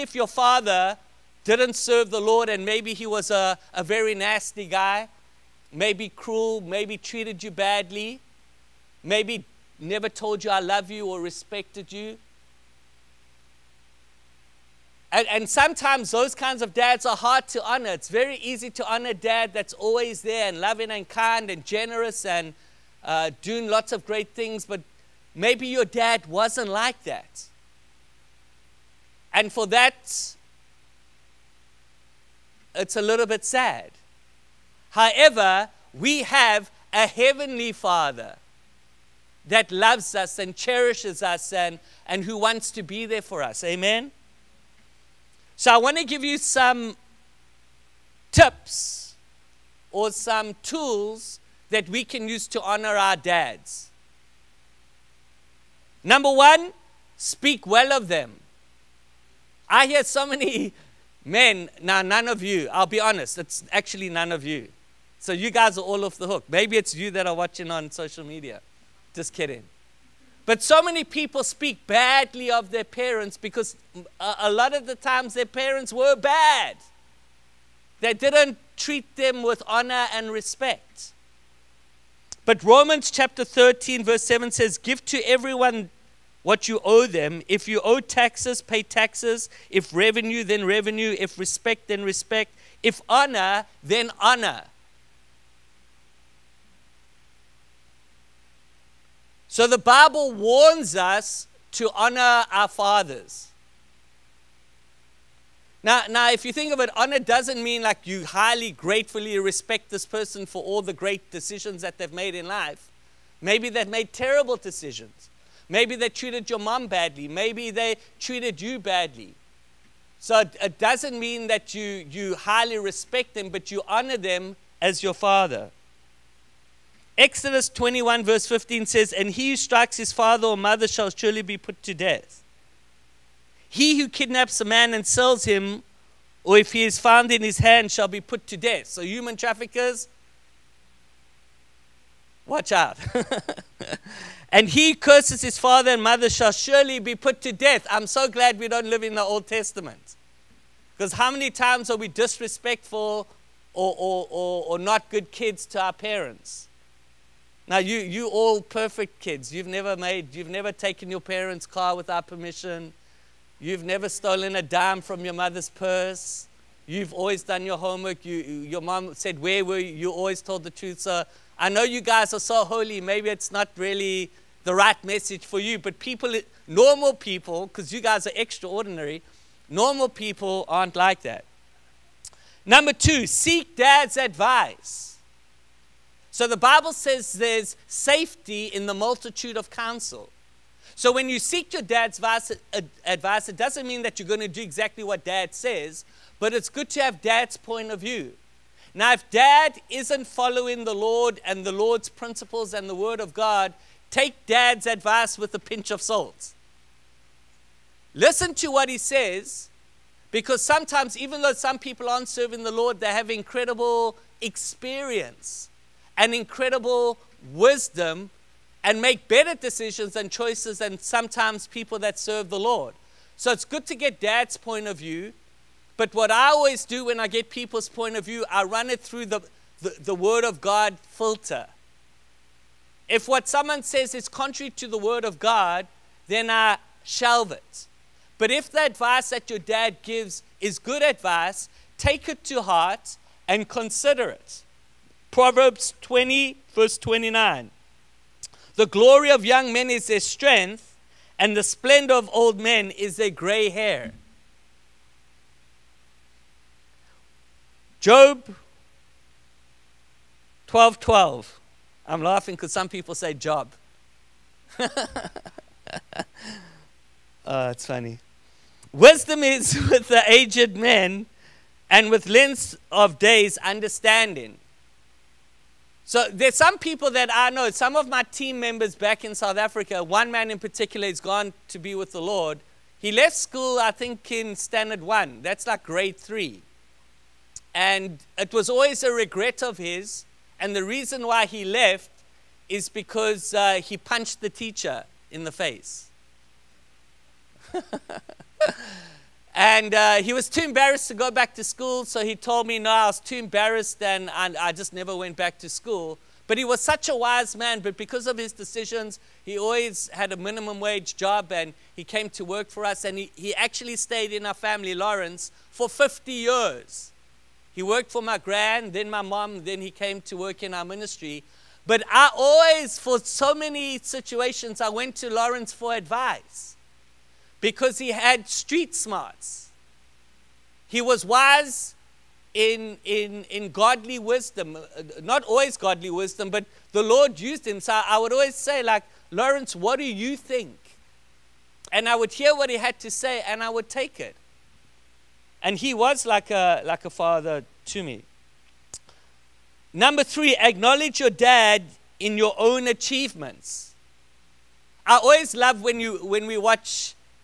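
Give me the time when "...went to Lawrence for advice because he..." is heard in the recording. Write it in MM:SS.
05:24.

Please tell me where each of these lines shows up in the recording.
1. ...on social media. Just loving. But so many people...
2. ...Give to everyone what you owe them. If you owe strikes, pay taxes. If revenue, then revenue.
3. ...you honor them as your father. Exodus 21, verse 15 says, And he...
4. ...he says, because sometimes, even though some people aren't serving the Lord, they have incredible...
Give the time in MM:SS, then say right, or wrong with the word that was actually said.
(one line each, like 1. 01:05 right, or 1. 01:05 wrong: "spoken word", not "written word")
1. 01:07 wrong: "kidding", not "loving"
2. 01:24 wrong: "taxes", not "strikes"
3. 02:03 right
4. 03:28 right.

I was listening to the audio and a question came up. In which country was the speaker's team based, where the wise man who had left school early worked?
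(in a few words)
South Africa.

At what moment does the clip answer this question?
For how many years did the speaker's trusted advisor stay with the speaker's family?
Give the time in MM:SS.
05:15.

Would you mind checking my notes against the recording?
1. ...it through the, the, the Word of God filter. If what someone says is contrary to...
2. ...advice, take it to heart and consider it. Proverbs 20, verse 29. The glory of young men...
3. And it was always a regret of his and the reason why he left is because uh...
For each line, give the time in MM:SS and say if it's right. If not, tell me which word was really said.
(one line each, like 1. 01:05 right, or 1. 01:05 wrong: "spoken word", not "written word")
1. 03:48 right
2. 04:01 right
3. 04:47 right.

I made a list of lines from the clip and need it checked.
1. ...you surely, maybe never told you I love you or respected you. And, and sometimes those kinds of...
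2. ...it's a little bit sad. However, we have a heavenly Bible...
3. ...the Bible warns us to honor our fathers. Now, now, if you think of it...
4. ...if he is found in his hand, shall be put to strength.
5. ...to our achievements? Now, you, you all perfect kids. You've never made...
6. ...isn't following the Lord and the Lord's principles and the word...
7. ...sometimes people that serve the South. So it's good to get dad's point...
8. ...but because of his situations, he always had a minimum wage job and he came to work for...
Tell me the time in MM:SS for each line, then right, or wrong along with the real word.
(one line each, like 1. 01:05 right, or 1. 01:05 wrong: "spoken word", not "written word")
1. 00:07 wrong: "badly", not "surely"
2. 00:32 wrong: "Father", not "Bible"
3. 01:39 right
4. 02:16 wrong: "death", not "strength"
5. 02:35 wrong: "parents", not "achievements"
6. 03:19 right
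7. 03:40 wrong: "Lord", not "South"
8. 05:07 wrong: "decisions", not "situations".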